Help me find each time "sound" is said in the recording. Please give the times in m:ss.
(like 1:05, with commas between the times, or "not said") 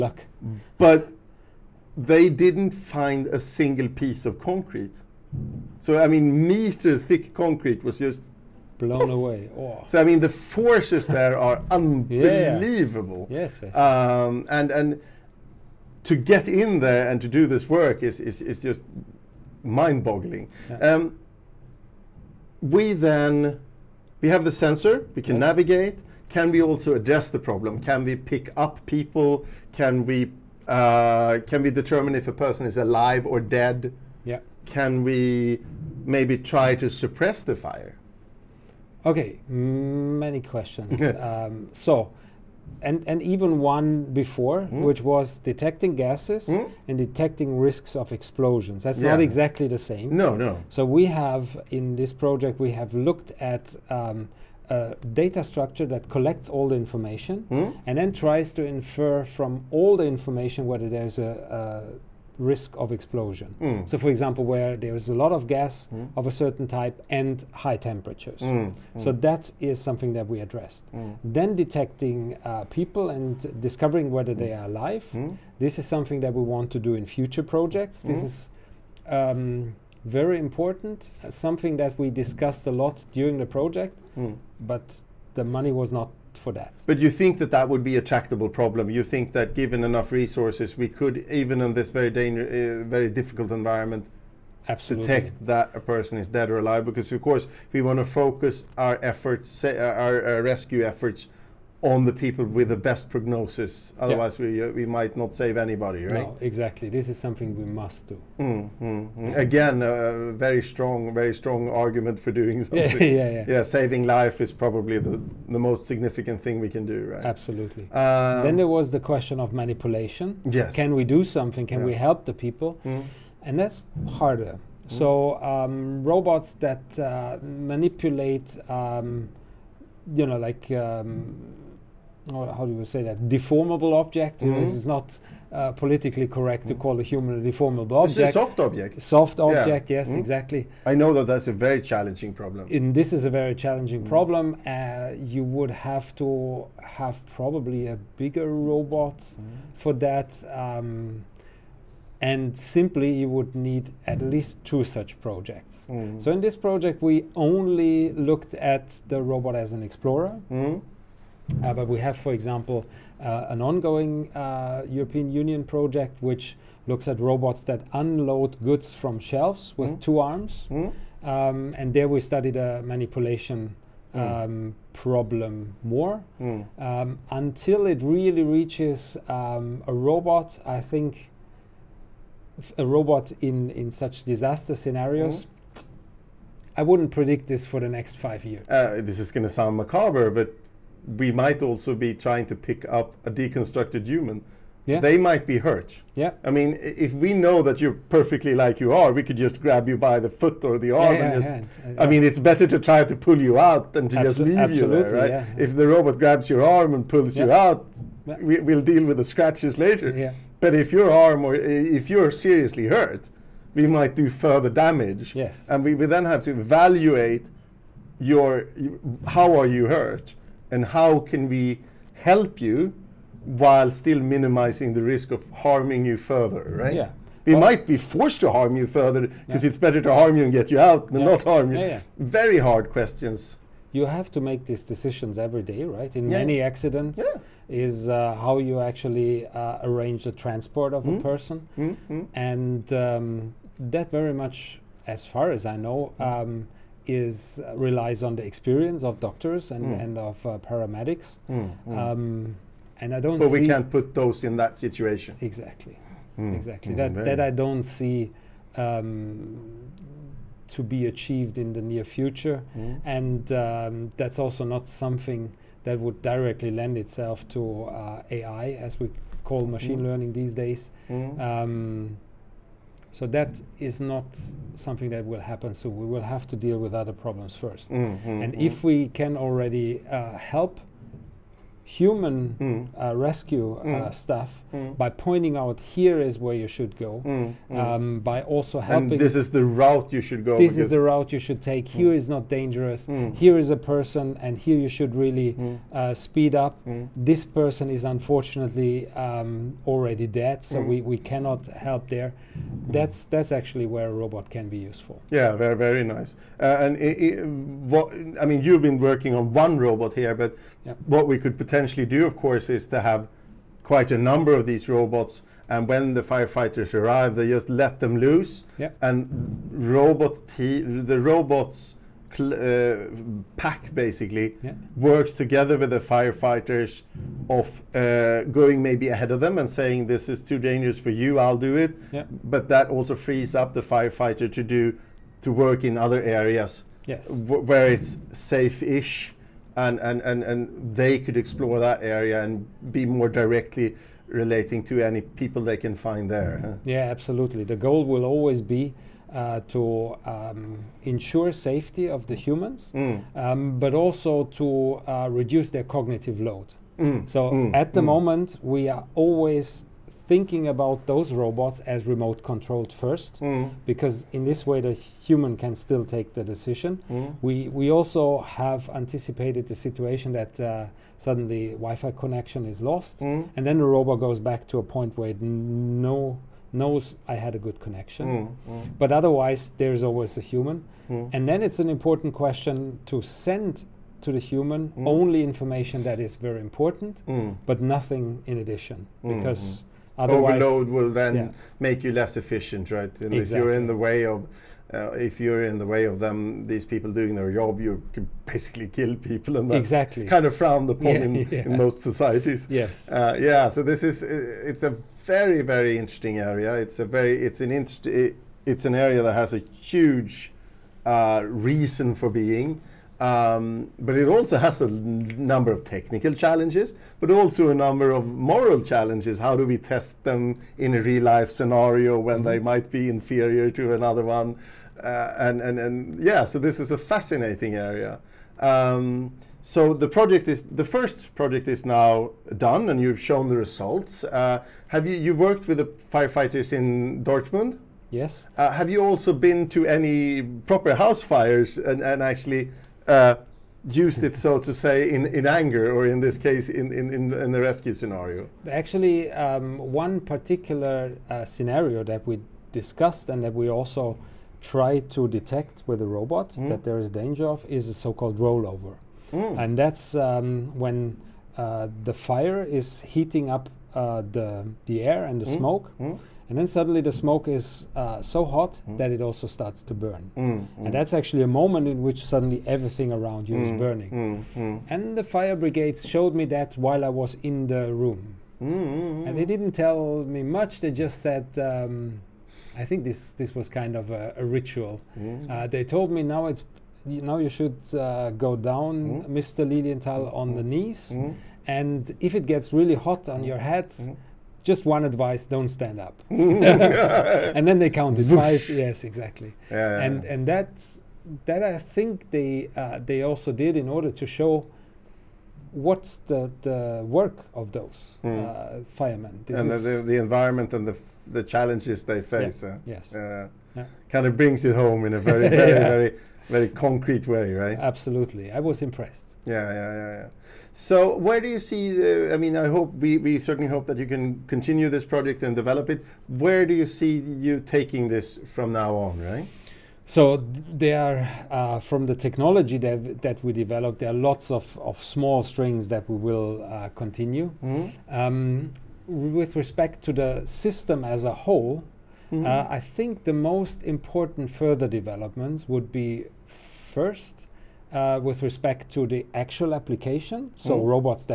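3:09.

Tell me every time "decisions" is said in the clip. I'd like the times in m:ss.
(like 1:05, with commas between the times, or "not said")
3:54, 6:06.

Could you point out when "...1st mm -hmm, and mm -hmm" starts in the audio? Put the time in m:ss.
4:37.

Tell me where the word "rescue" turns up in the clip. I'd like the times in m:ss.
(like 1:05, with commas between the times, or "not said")
1:40, 4:43, 7:27.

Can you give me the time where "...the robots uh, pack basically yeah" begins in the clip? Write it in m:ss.
5:20.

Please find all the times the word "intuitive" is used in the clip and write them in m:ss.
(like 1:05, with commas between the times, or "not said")
not said.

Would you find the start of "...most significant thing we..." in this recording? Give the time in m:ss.
1:55.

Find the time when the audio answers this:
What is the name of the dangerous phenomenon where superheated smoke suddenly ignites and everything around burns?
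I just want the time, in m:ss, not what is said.
7:38.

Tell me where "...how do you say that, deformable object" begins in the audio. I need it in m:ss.
2:12.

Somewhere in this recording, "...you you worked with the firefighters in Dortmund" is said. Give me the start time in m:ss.
7:15.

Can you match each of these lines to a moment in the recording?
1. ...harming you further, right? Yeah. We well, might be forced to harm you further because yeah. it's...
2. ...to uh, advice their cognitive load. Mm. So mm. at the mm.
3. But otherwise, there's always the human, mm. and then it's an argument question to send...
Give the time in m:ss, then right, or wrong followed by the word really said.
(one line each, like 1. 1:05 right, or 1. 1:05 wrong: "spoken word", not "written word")
1. 3:45 right
2. 5:54 wrong: "reduce", not "advice"
3. 6:19 wrong: "important", not "argument".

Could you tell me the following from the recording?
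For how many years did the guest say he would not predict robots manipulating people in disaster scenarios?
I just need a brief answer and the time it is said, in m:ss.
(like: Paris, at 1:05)
5 years, at 3:08.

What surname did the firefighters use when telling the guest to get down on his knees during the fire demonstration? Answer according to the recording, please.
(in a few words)
Lilienthal.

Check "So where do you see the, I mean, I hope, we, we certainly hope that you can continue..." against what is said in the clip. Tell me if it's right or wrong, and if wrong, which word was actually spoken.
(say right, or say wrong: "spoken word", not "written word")
right.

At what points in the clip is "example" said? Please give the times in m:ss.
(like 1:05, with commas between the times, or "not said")
1:04, 2:42.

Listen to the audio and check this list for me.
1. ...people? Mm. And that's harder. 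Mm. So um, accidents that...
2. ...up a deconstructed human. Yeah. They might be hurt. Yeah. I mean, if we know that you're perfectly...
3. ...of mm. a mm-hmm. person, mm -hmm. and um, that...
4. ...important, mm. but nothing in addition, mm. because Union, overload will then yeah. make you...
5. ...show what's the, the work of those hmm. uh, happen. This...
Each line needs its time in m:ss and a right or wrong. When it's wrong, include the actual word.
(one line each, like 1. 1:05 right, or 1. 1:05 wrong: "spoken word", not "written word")
1. 2:02 wrong: "robots", not "accidents"
2. 3:12 right
3. 4:00 right
4. 6:26 wrong: "Otherwise", not "Union"
5. 8:24 wrong: "firemen", not "happen".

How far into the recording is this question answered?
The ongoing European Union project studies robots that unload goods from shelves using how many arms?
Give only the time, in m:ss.
2:50.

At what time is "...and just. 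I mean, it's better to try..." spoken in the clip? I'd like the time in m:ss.
3:21.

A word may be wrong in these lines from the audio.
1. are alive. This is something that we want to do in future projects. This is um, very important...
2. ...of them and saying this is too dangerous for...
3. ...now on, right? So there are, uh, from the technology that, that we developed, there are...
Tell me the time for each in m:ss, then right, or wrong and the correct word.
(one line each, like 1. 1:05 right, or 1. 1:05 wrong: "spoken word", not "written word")
1. 1:14 right
2. 5:29 right
3. 8:48 right.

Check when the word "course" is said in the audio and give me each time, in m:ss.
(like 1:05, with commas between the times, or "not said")
1:37, 5:12.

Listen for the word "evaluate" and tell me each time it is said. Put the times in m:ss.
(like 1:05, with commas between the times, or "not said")
3:36.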